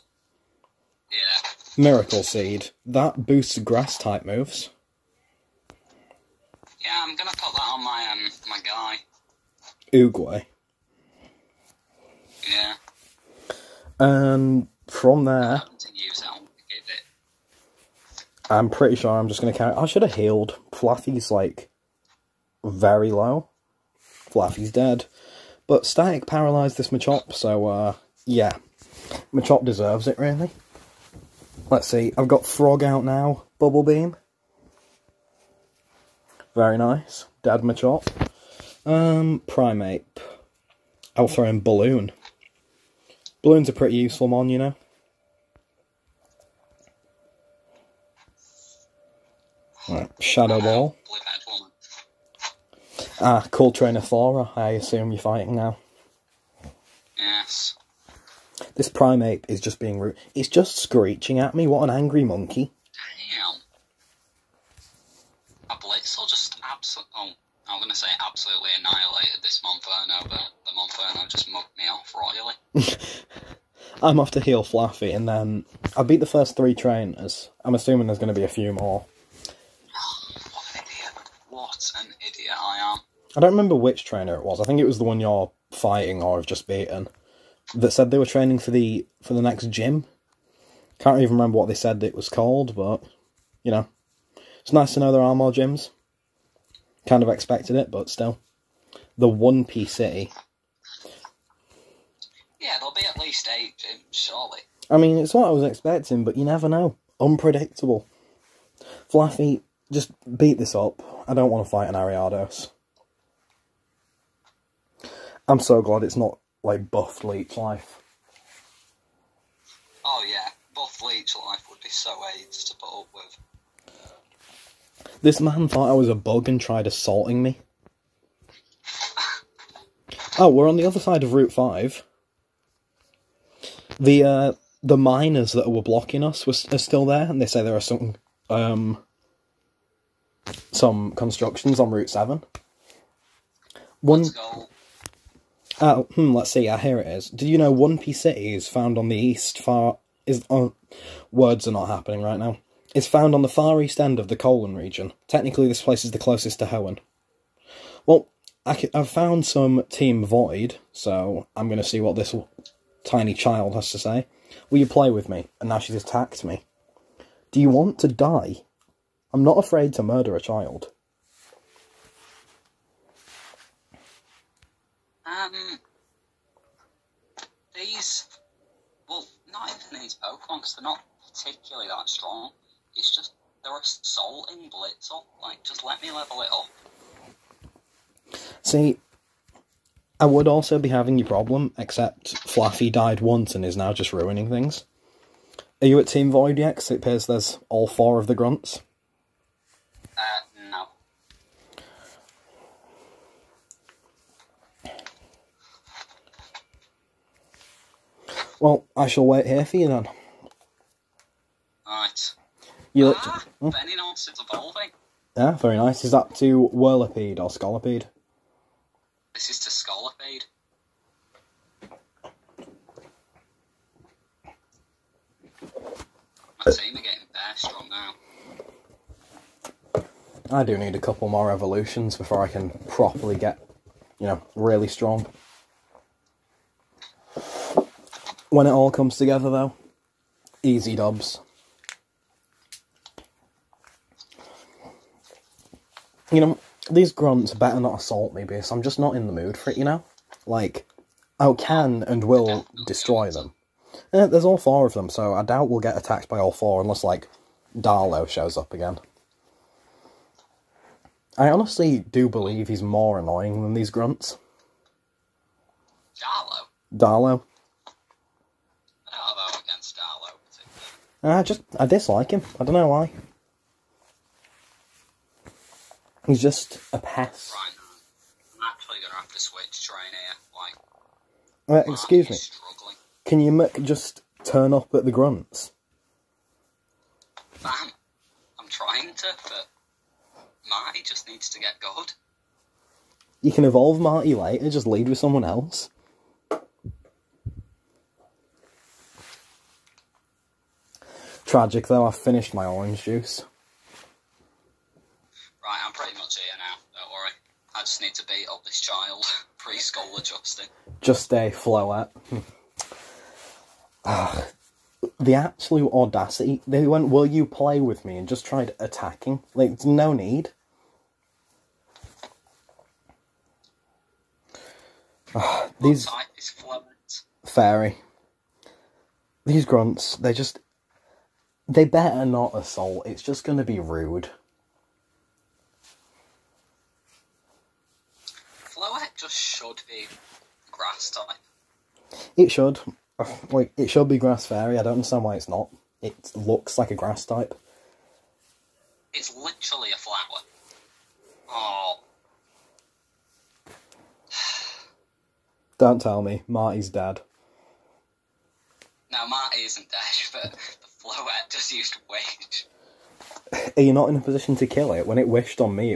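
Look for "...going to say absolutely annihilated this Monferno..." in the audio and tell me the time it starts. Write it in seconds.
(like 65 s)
67 s.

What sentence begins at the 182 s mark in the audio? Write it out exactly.
It's just, they're assaulting Blitz up.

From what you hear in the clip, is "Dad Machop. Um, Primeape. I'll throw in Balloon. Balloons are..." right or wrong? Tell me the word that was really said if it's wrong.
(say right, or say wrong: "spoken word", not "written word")
right.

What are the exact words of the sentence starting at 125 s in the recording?
This man thought I was a bug and tried assaulting me.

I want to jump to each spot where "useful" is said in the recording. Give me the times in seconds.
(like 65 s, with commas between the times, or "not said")
43 s.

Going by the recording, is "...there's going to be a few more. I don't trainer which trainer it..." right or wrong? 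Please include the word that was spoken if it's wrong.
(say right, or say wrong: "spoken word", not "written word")
wrong: "remember", not "trainer".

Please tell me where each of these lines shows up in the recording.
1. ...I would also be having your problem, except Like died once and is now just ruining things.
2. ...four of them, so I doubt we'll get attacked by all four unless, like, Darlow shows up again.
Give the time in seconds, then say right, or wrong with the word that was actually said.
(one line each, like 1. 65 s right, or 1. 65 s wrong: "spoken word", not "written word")
1. 190 s wrong: "Fluffy", not "Like"
2. 254 s right.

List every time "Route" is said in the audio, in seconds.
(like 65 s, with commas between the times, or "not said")
131 s, 141 s.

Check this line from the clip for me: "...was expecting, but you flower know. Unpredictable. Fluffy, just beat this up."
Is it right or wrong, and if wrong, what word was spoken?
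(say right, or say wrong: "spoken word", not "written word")
wrong: "never", not "flower".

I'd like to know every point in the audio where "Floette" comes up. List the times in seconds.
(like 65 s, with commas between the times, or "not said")
311 s, 338 s, 361 s.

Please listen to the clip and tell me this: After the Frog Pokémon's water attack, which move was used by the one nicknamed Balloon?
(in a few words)
Shadow Ball.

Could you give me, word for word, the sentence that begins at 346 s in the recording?
It looks like a grass type.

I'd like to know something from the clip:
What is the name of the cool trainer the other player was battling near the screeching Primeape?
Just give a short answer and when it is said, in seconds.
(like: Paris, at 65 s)
Flora, at 54 s.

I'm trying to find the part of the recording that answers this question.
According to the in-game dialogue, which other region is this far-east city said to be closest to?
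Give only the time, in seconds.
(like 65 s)
156 s.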